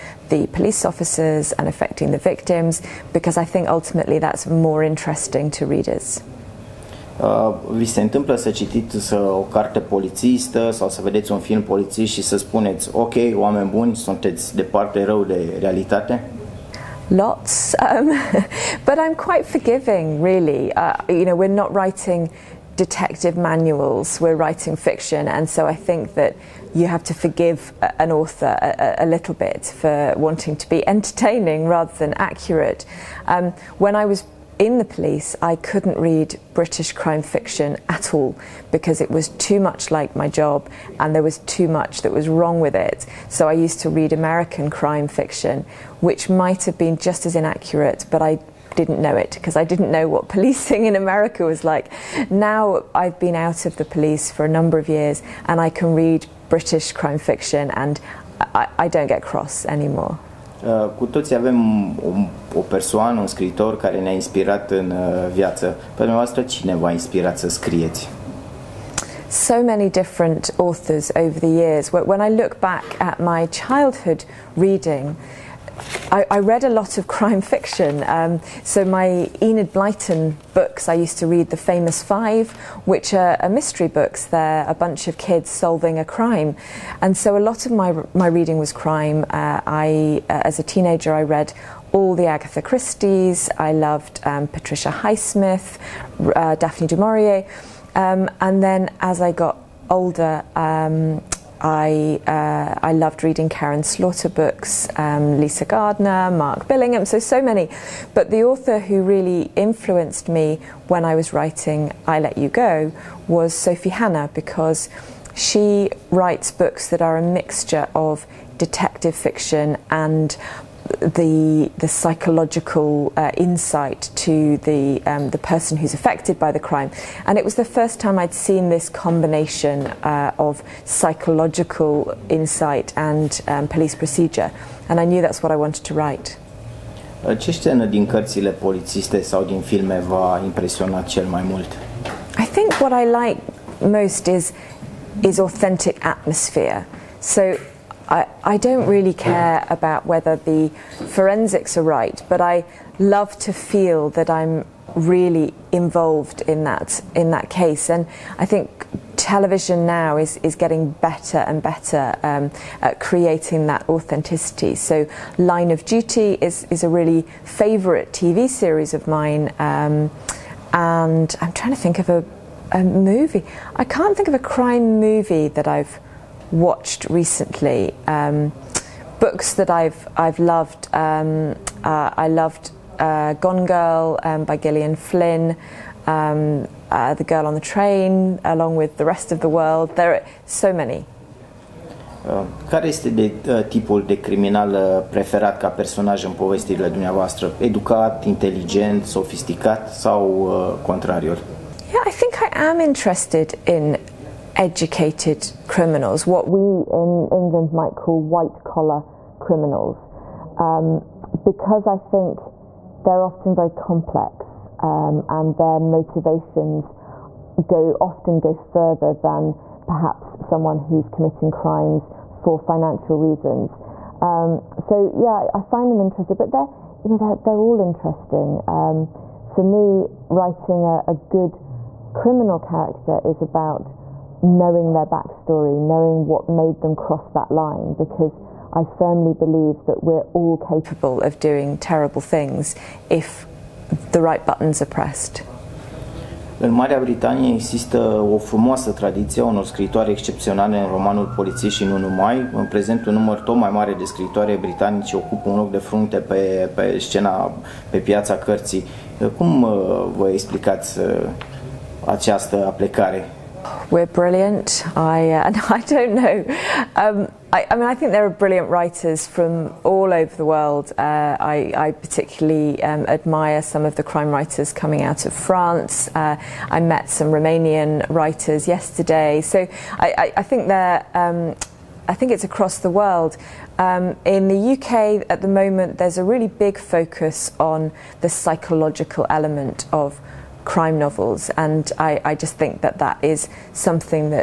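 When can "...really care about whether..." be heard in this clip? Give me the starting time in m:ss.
2:28.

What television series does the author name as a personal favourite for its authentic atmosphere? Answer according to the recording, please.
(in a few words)
Line of Duty.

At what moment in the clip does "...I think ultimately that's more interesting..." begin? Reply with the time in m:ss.
0:03.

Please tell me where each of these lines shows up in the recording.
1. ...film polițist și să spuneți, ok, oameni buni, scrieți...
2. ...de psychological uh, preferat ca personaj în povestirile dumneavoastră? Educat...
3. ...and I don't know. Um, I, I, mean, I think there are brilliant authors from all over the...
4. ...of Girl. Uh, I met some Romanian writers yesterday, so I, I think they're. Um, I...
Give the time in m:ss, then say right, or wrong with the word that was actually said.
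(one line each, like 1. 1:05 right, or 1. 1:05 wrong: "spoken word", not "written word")
1. 0:11 wrong: "sunteți", not "scrieți"
2. 3:14 wrong: "criminal", not "psychological"
3. 4:25 wrong: "writers", not "authors"
4. 4:35 wrong: "France", not "Girl".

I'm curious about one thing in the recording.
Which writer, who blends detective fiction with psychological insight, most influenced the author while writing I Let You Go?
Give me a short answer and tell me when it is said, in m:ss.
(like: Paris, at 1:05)
Sophie Hannah, at 1:53.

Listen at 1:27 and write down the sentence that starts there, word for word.
And so a lot of my, my reading was crime.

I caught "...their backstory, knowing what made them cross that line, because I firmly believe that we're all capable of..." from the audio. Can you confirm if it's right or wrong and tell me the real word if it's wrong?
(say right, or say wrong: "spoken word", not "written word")
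right.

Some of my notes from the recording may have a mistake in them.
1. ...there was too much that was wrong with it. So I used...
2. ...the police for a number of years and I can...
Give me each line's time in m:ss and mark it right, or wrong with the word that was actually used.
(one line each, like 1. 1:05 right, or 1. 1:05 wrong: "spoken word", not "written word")
1. 0:41 right
2. 0:53 right.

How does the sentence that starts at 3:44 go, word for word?
Um, so yeah, I find them interesting, but they're you know they're they're all interesting.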